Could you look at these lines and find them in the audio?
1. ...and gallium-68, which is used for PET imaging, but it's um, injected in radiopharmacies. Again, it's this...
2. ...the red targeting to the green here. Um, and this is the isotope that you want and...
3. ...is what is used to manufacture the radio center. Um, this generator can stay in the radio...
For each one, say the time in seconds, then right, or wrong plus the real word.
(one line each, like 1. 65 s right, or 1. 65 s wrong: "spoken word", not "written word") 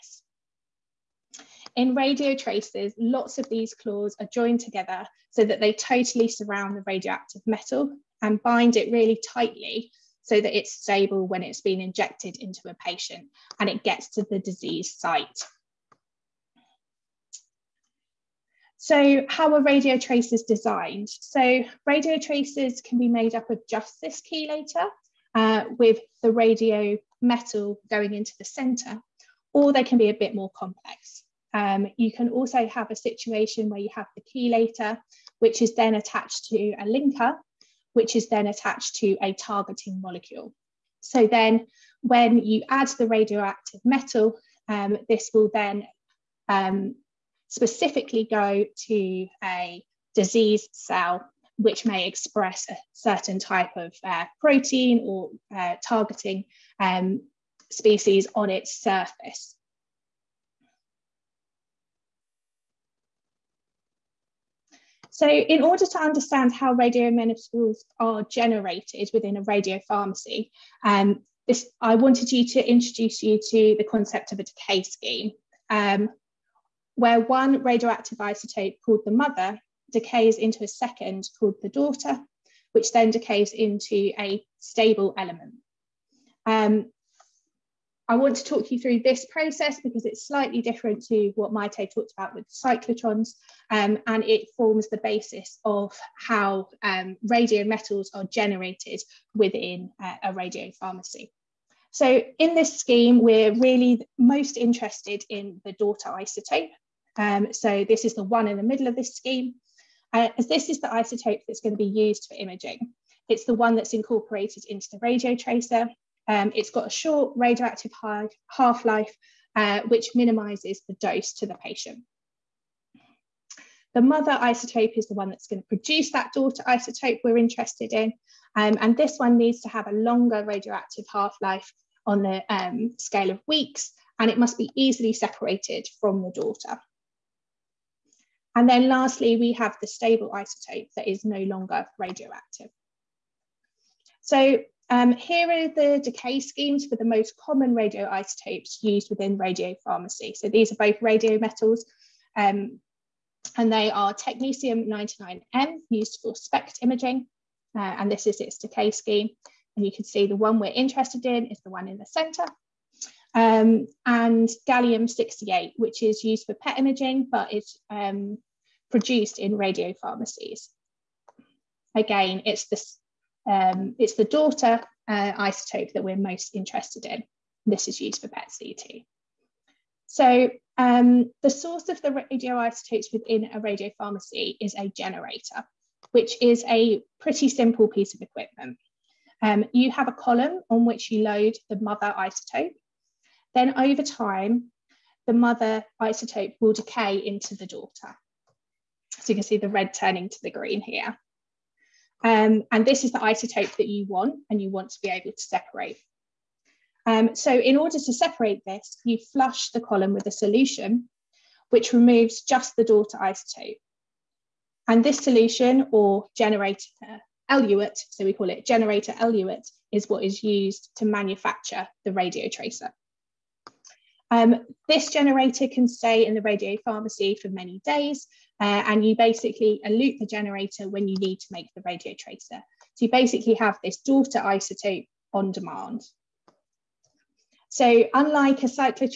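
1. 164 s wrong: "produced", not "injected"
2. 199 s wrong: "turning", not "targeting"
3. 219 s wrong: "tracer", not "center".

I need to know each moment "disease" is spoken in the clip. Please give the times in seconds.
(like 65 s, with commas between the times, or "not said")
14 s, 50 s.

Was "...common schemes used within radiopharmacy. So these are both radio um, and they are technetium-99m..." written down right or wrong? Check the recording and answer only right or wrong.
wrong.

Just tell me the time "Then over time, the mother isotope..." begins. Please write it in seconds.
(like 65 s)
193 s.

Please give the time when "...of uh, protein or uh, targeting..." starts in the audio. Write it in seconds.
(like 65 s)
53 s.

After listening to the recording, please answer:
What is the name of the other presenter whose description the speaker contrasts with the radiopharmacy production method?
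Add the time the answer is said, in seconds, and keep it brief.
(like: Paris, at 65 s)
Maite, at 91 s.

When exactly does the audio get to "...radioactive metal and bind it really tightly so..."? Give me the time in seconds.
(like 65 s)
6 s.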